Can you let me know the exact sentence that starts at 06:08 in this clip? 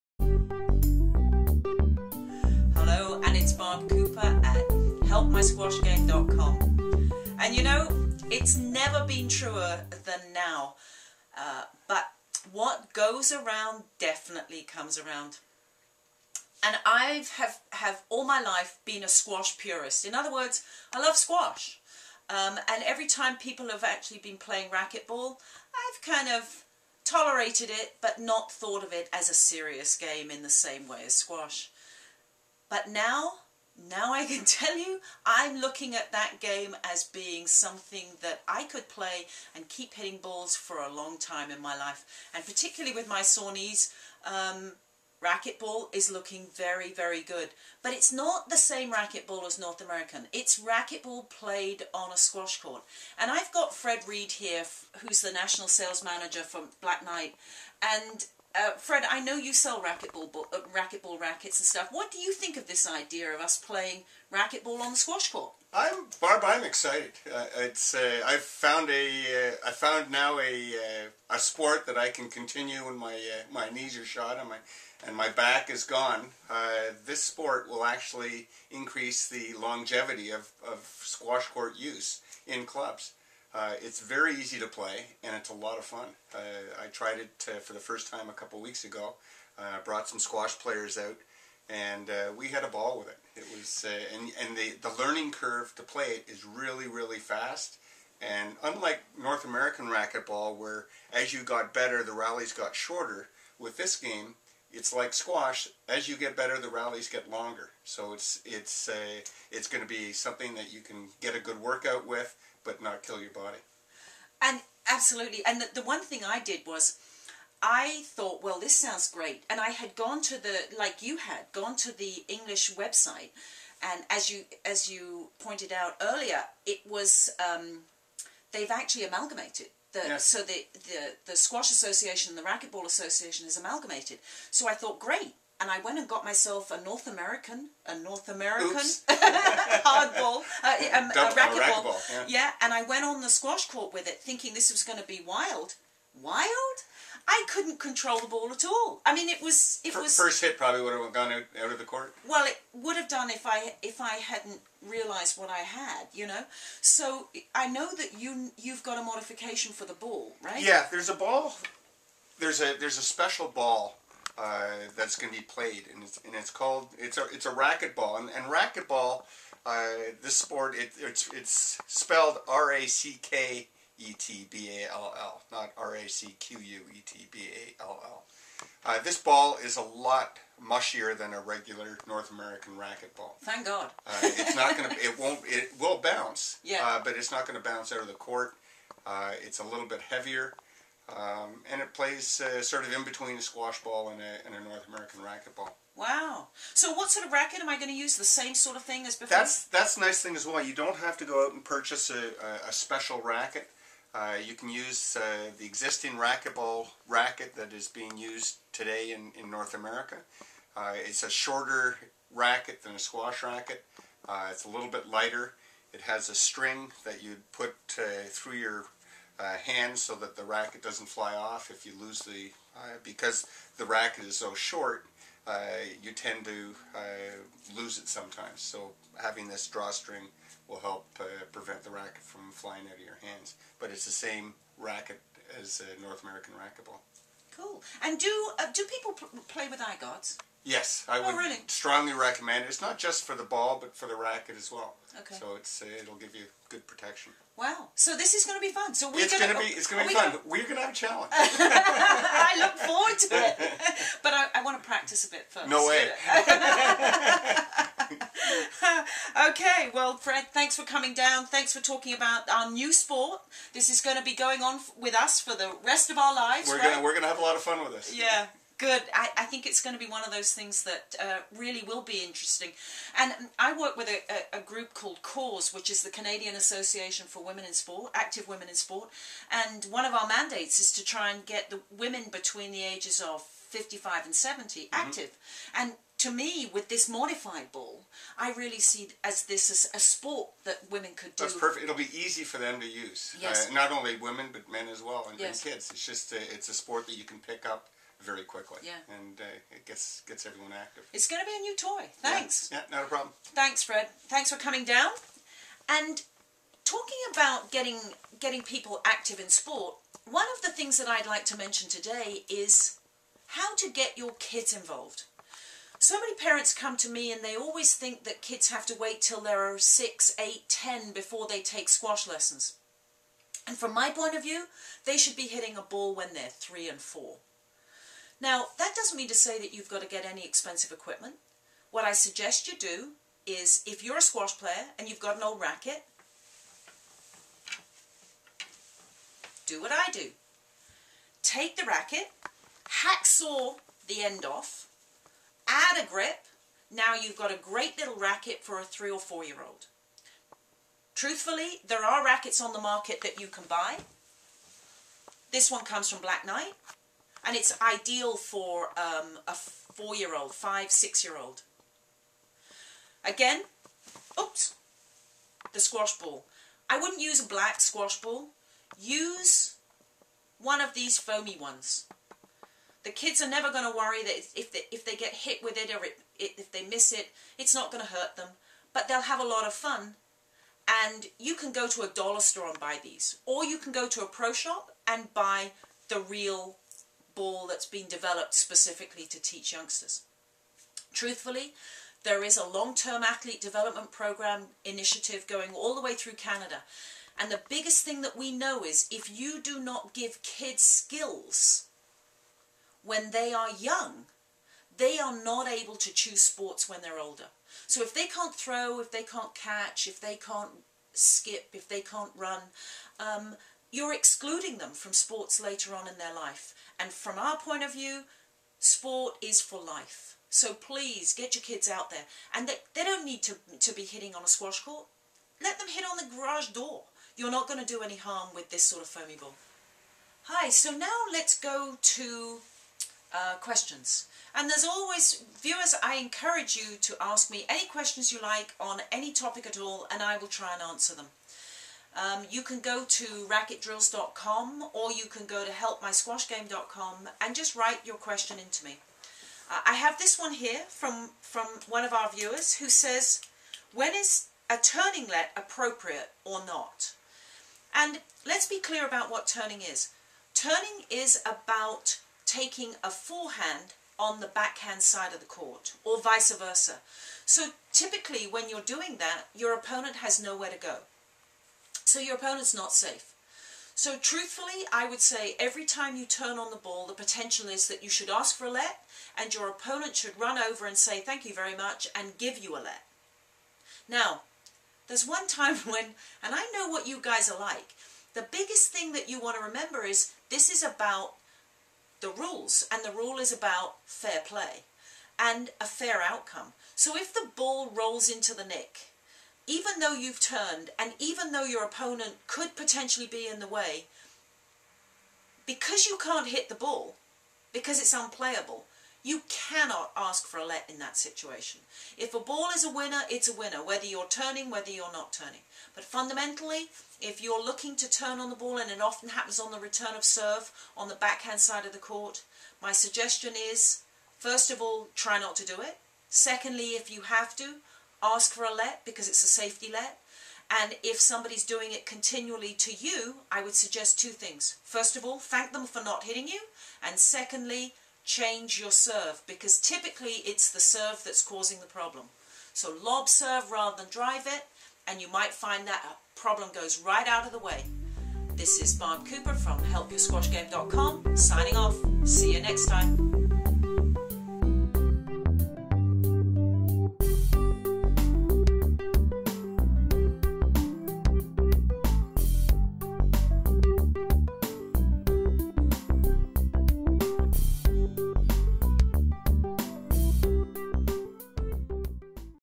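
Use one of these foamy ones.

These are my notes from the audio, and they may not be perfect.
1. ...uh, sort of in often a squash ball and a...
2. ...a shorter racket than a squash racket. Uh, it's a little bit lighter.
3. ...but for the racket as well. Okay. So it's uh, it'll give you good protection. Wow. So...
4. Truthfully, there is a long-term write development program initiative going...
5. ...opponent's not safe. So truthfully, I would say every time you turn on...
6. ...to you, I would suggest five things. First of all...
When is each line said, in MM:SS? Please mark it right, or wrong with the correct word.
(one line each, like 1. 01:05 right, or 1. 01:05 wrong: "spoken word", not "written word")
1. 03:12 wrong: "between", not "often"
2. 03:31 right
3. 04:03 right
4. 06:31 wrong: "athlete", not "write"
5. 07:52 right
6. 08:52 wrong: "two", not "five".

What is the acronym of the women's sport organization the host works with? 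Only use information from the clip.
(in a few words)
CAAWS.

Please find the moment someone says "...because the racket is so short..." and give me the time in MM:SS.
03:43.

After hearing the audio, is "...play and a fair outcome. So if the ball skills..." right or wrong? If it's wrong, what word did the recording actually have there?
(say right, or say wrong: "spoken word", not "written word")
wrong: "rolls", not "skills".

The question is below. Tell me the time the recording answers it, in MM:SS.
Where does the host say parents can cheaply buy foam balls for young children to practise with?
06:22.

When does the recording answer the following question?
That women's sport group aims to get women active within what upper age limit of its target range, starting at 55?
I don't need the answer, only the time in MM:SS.
04:44.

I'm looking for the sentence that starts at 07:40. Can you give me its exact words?
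Turning is about taking a forehand on the backhand side of the court or vice versa.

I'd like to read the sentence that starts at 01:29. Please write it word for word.
Uh, brought some squash players out, and uh, we had a ball with it.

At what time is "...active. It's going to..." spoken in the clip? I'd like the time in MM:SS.
05:00.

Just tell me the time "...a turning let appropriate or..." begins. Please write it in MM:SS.
07:34.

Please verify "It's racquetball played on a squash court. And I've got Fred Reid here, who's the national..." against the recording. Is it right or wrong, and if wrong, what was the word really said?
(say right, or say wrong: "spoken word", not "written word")
right.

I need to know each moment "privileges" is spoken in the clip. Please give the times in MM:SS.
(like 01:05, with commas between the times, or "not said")
not said.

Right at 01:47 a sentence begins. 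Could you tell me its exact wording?
So it's it's it's going to be something that you can get a good workout with but not kill your body.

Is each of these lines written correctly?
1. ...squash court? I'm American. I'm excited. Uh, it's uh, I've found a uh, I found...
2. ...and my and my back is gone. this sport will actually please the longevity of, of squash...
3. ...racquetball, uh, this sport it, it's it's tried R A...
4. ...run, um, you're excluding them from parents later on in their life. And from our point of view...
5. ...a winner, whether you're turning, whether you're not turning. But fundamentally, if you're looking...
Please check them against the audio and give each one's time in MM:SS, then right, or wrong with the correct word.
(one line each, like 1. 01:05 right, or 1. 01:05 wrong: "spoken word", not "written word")
1. 01:04 wrong: "Barb", not "American"
2. 01:14 wrong: "increase", not "please"
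3. 02:48 wrong: "spelled", not "tried"
4. 06:52 wrong: "sports", not "parents"
5. 08:33 right.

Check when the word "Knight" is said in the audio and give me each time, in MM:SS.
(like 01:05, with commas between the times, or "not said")
00:57, 05:56.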